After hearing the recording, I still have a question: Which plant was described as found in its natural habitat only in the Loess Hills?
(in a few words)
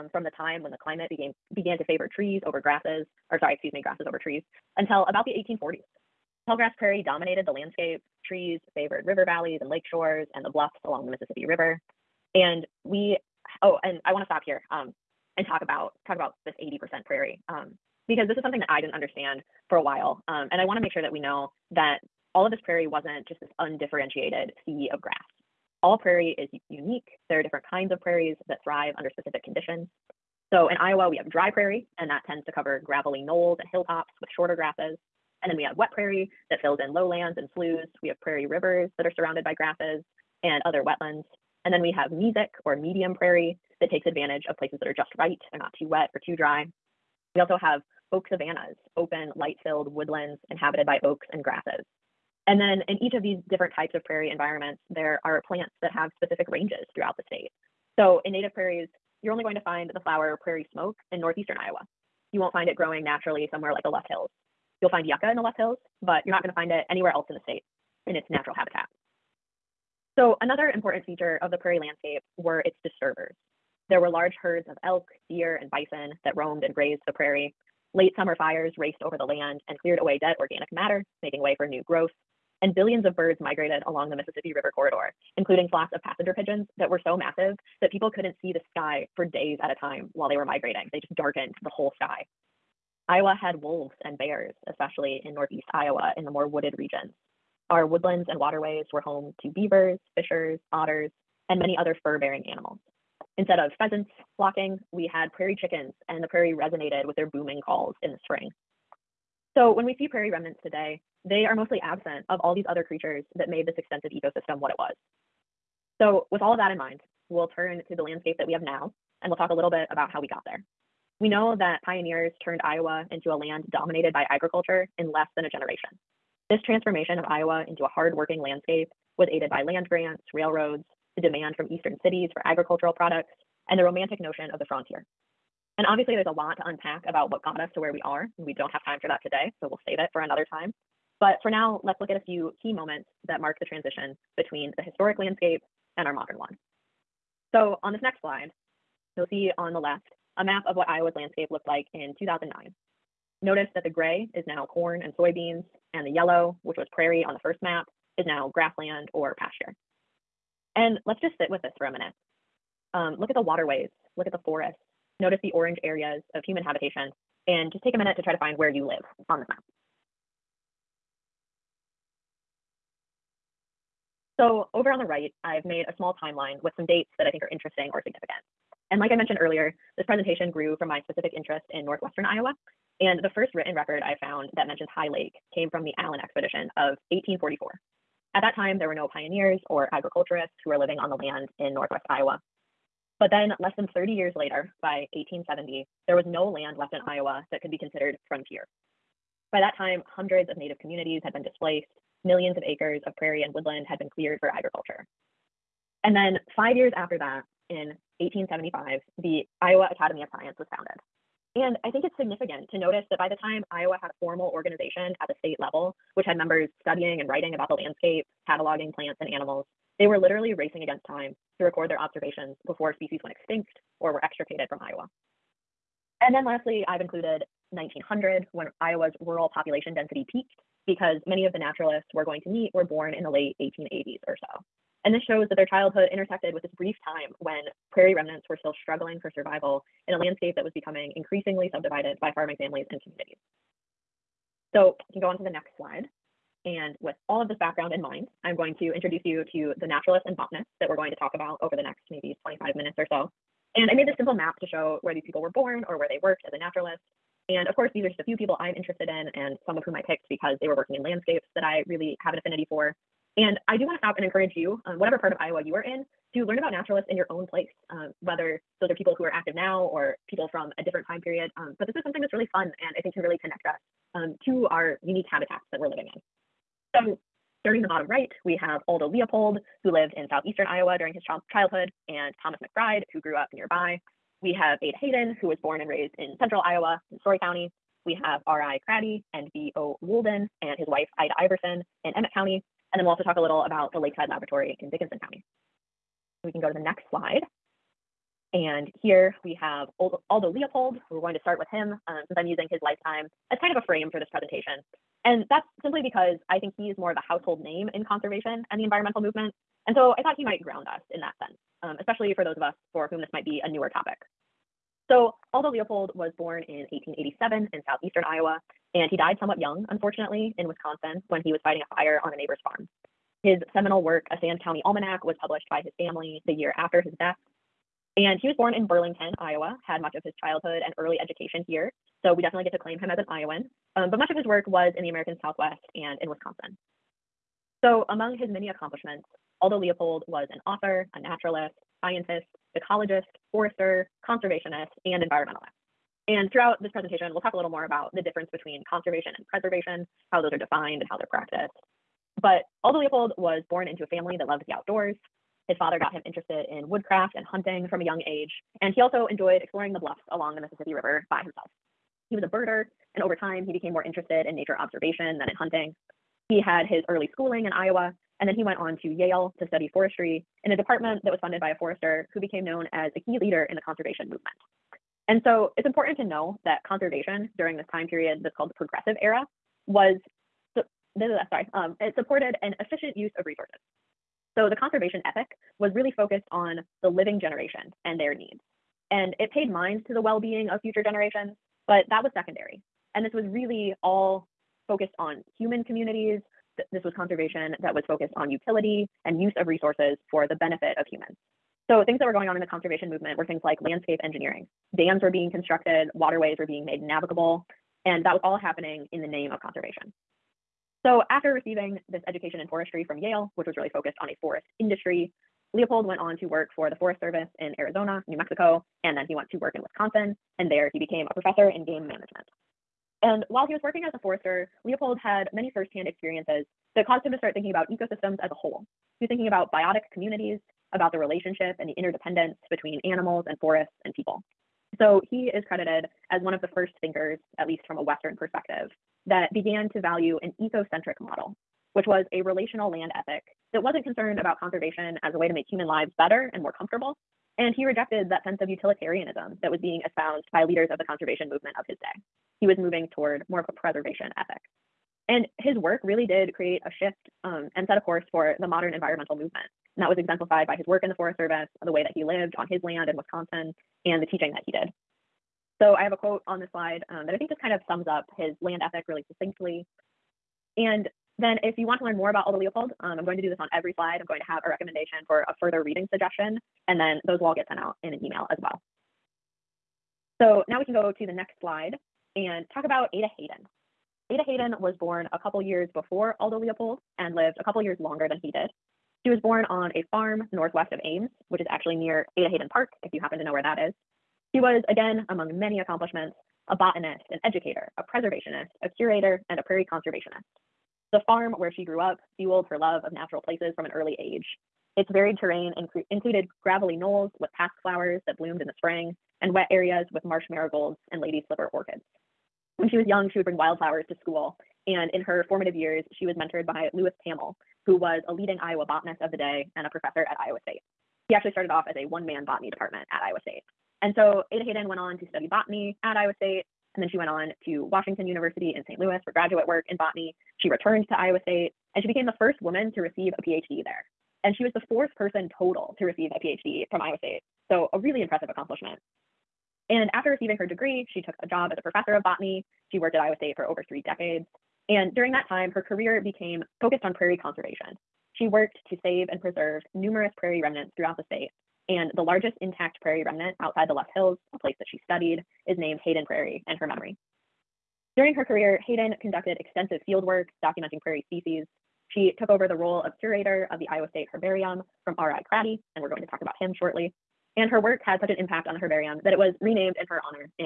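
Yucca.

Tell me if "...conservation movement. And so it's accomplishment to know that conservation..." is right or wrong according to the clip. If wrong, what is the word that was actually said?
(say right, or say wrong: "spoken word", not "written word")
wrong: "important", not "accomplishment".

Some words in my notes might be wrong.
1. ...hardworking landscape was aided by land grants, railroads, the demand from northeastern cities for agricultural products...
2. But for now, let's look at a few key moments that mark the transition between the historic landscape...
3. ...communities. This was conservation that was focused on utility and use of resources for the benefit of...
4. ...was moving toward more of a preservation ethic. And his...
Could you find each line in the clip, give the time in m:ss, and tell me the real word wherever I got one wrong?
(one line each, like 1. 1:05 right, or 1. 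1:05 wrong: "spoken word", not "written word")
1. 2:07 wrong: "eastern", not "northeastern"
2. 2:21 right
3. 6:35 right
4. 7:32 right.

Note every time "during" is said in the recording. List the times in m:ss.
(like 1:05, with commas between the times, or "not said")
4:40, 6:17, 9:05, 9:18.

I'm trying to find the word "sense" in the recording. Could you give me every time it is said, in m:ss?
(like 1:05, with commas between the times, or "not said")
5:11, 7:28.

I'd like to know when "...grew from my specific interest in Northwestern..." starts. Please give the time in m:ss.
3:00.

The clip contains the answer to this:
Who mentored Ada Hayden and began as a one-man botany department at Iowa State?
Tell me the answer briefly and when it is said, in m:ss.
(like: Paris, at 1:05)
Louis Pammel, at 8:36.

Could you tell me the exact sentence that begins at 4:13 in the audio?
And I made this simple map to show where these people were born or where they worked as a naturalist.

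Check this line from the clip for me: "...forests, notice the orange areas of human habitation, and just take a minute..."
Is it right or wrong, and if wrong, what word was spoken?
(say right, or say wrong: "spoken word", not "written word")
right.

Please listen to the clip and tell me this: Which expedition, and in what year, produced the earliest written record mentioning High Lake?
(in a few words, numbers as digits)
Allen expedition of 1844.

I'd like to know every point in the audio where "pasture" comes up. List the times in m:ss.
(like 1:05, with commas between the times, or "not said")
2:39.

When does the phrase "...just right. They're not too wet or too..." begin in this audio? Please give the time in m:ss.
0:44.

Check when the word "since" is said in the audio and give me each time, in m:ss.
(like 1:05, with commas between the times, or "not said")
5:02.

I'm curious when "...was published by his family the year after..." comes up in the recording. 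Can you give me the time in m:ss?
5:25.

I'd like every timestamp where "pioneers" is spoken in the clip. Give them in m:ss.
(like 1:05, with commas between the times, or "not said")
2:01, 3:09.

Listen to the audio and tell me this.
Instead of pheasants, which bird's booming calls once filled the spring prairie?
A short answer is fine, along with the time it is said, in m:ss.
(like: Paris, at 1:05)
Prairie chickens, at 1:45.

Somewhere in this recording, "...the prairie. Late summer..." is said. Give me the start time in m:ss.
1:17.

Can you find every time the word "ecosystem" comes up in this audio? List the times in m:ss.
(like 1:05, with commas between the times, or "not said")
1:54, 7:07.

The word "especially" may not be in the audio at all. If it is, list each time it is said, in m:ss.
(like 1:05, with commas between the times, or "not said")
1:34, 5:11.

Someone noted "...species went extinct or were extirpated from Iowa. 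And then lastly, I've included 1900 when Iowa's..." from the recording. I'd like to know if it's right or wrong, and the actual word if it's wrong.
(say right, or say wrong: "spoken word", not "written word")
right.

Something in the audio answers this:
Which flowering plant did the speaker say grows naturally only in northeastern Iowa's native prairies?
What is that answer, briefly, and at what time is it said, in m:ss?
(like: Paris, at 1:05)
Prairie smoke, at 1:00.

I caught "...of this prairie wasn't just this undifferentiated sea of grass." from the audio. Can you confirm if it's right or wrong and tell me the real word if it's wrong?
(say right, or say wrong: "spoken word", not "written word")
right.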